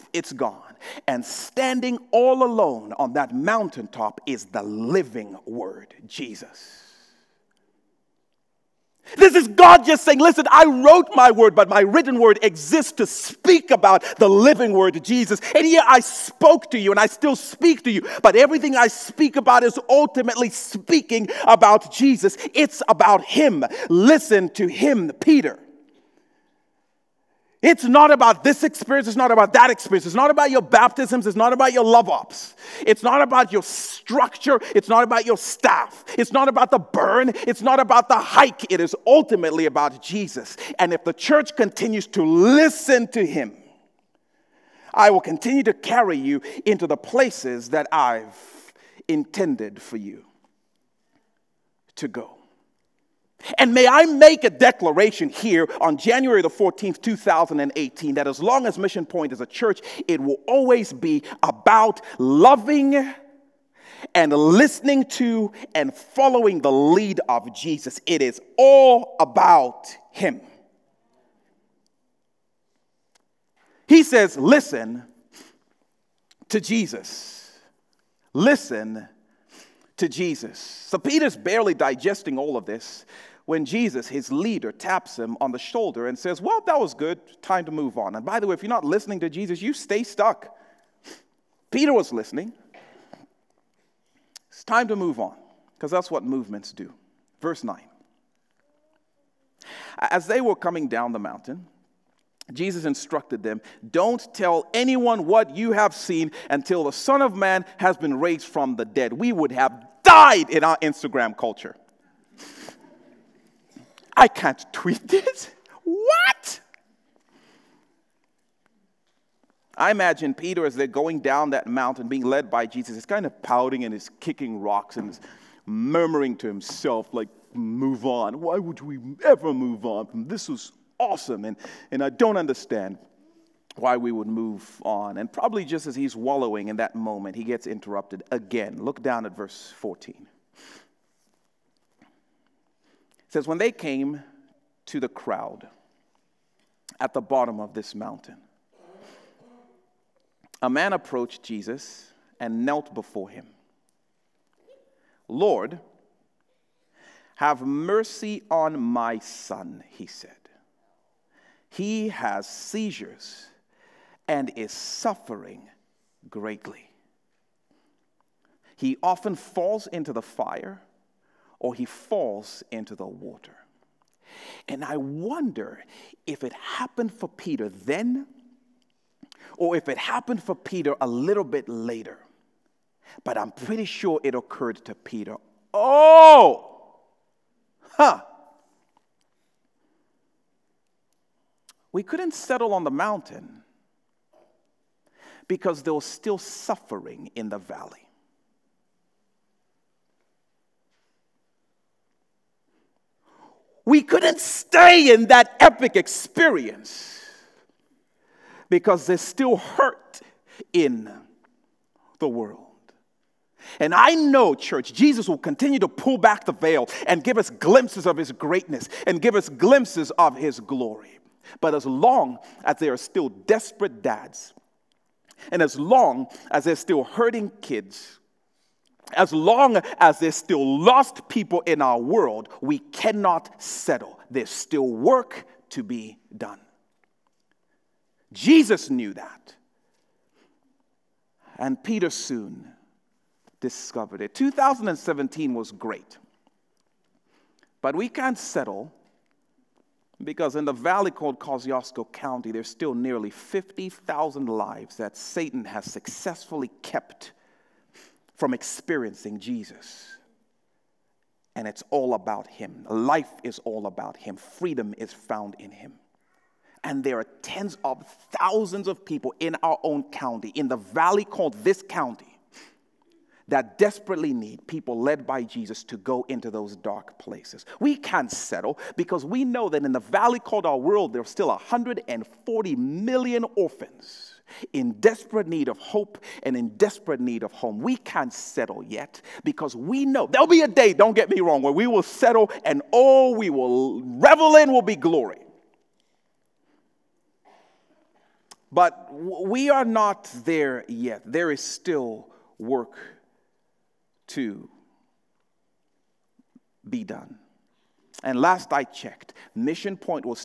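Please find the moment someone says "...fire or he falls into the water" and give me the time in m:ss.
2:50.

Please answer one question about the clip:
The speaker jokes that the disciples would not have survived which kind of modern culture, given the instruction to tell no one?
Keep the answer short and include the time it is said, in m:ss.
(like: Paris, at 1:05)
Instagram culture, at 1:50.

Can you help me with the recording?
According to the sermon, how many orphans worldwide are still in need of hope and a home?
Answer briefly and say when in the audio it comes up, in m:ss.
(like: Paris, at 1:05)
140 million, at 4:41.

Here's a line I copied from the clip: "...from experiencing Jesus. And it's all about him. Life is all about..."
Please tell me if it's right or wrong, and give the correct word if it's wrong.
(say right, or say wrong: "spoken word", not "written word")
right.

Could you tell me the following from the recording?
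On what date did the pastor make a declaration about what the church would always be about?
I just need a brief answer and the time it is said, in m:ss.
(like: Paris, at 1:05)
January 14, 2018, at 0:55.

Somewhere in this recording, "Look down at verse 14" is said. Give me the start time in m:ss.
2:18.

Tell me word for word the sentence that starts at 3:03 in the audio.
But I'm pretty sure it occurred to Peter.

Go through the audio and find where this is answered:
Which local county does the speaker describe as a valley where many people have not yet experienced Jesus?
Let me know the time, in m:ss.
4:11.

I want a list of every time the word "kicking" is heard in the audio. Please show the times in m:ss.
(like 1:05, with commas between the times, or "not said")
2:04.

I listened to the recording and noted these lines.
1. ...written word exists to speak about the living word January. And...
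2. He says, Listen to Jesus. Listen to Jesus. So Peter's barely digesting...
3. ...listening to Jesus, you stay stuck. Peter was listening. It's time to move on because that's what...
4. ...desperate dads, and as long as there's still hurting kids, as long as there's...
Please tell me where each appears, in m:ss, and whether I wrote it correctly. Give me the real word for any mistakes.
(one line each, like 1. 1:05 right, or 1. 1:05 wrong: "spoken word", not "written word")
1. 0:11 wrong: "Jesus", not "January"
2. 1:13 right
3. 1:28 right
4. 3:43 right.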